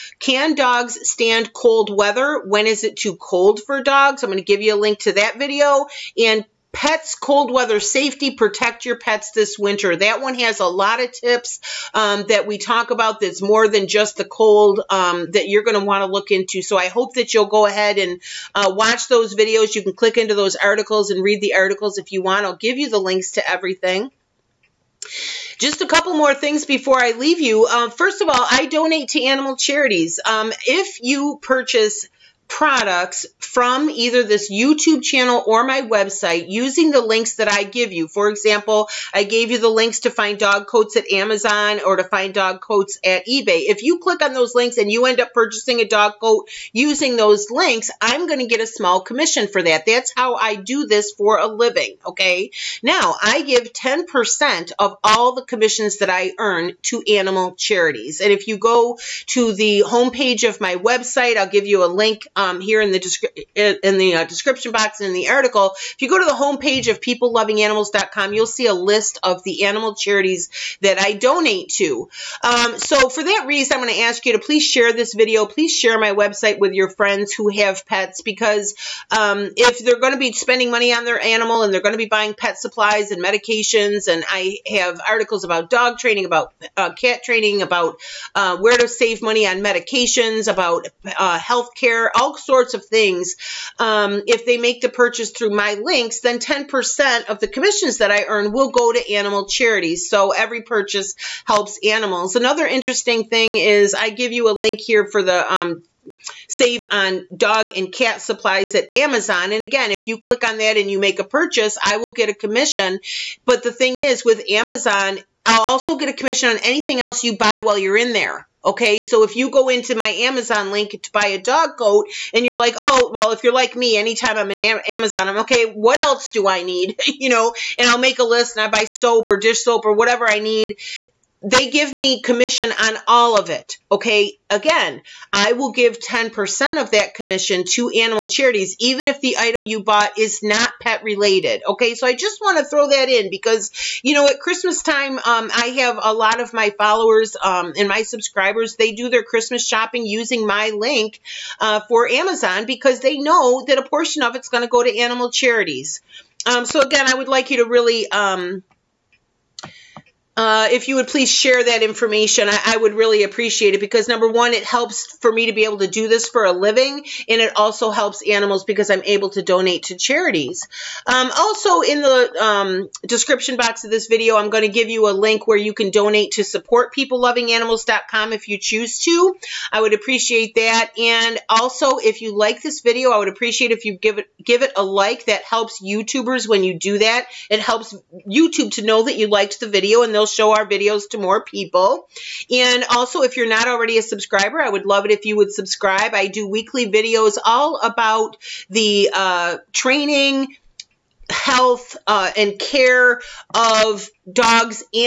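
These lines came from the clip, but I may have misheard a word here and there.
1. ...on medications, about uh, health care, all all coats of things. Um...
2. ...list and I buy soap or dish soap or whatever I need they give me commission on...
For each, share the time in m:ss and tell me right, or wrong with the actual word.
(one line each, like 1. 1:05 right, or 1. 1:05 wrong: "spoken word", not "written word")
1. 1:29 wrong: "sorts", not "coats"
2. 2:08 right.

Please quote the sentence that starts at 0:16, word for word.
So I hope that you'll go ahead and uh, watch those videos.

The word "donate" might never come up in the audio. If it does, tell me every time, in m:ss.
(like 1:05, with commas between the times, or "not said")
0:28, 1:11, 2:49, 2:55.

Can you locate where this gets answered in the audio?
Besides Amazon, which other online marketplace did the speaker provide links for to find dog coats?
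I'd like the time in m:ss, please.
0:43.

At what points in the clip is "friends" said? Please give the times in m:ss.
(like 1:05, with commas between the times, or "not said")
1:16.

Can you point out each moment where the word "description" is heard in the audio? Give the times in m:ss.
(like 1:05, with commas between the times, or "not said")
1:04, 2:53.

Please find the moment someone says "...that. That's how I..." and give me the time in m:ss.
0:49.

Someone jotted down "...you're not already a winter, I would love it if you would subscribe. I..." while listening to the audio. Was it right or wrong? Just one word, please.
wrong.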